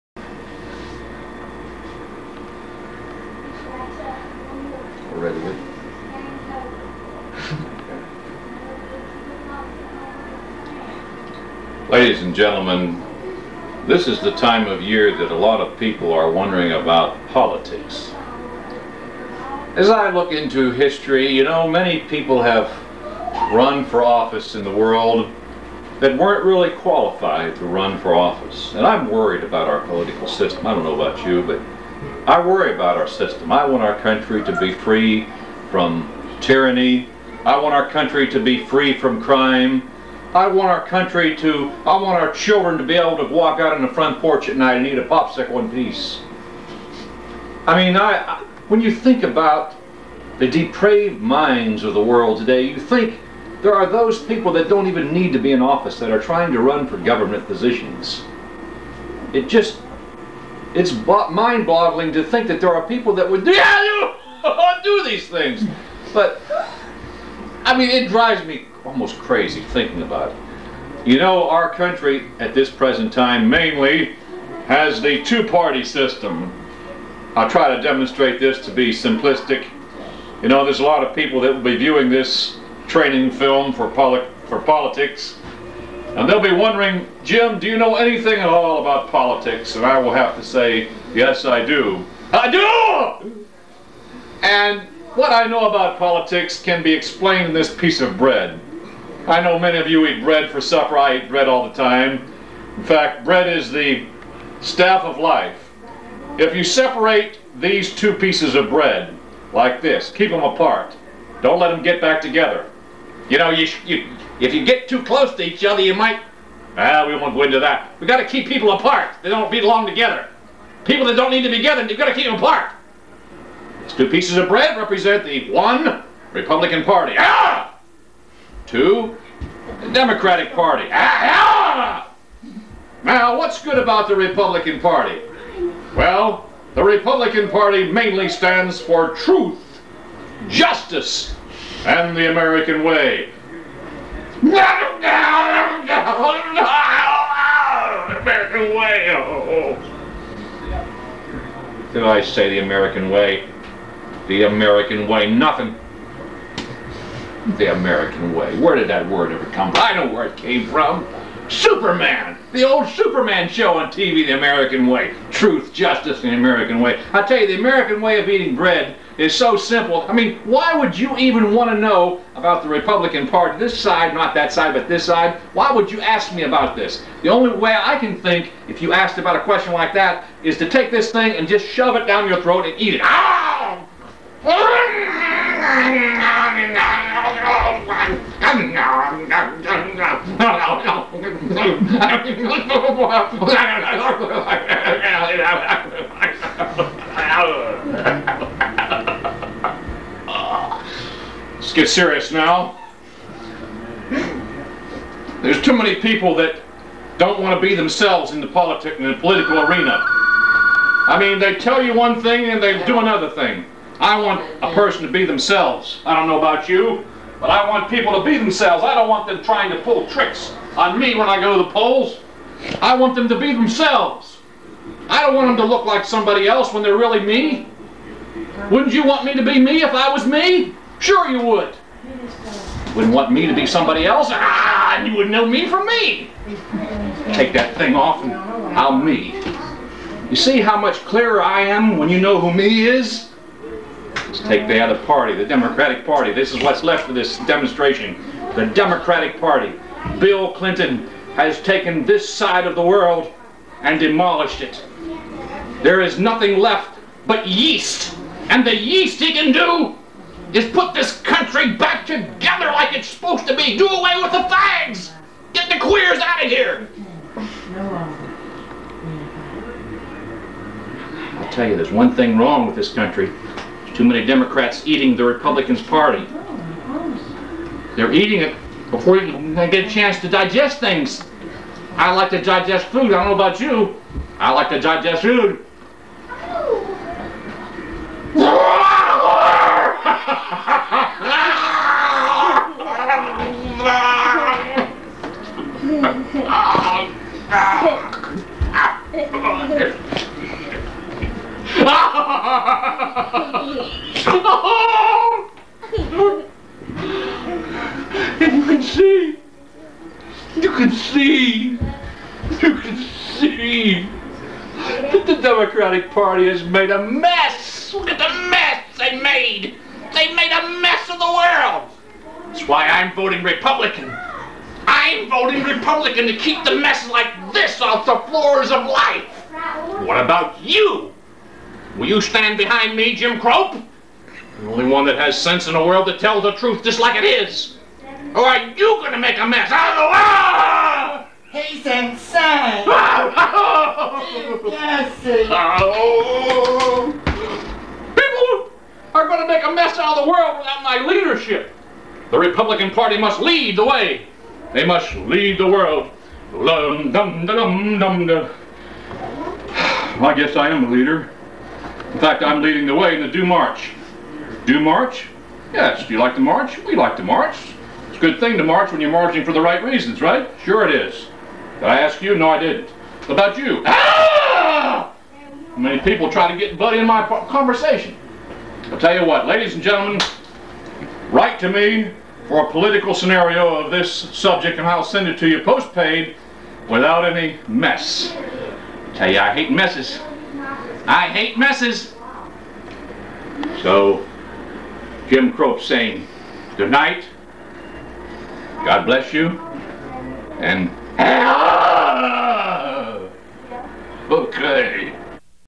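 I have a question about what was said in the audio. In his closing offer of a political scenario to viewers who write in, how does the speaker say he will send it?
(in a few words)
Postpaid.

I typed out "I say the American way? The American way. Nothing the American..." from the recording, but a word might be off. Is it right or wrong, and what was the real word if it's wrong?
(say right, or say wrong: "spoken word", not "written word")
right.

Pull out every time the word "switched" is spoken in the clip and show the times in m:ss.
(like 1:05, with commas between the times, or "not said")
not said.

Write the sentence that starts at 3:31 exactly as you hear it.
I mean, they tell you one thing and they do another thing.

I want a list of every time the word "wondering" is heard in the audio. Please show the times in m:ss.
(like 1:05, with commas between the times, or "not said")
0:16, 1:26.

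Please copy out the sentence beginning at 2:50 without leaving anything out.
I mean, why would you even want to know about the Republican Party?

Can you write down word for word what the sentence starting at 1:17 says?
I'll try to demonstrate this to be simplistic.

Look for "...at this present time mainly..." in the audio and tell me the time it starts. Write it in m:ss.
1:12.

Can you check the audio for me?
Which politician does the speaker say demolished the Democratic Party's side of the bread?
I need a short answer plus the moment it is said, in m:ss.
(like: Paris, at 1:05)
Bill Clinton, at 4:10.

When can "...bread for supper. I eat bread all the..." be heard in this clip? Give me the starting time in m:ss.
1:40.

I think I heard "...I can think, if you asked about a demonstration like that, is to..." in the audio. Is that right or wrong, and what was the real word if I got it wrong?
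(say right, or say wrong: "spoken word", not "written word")
wrong: "question", not "demonstration".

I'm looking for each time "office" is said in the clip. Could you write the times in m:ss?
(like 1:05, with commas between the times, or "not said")
0:24, 0:28, 0:55.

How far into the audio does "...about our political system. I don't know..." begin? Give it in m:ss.
0:29.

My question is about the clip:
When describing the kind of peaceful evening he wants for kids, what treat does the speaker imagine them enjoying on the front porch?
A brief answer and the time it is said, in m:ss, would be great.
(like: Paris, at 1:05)
A popsicle, at 0:45.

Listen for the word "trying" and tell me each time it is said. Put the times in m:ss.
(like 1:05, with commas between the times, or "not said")
0:56, 3:39.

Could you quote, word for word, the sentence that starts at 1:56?
Ah, we won't go into that.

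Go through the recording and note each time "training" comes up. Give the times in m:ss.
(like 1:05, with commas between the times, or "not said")
1:22.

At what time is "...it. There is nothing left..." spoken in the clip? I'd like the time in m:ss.
4:14.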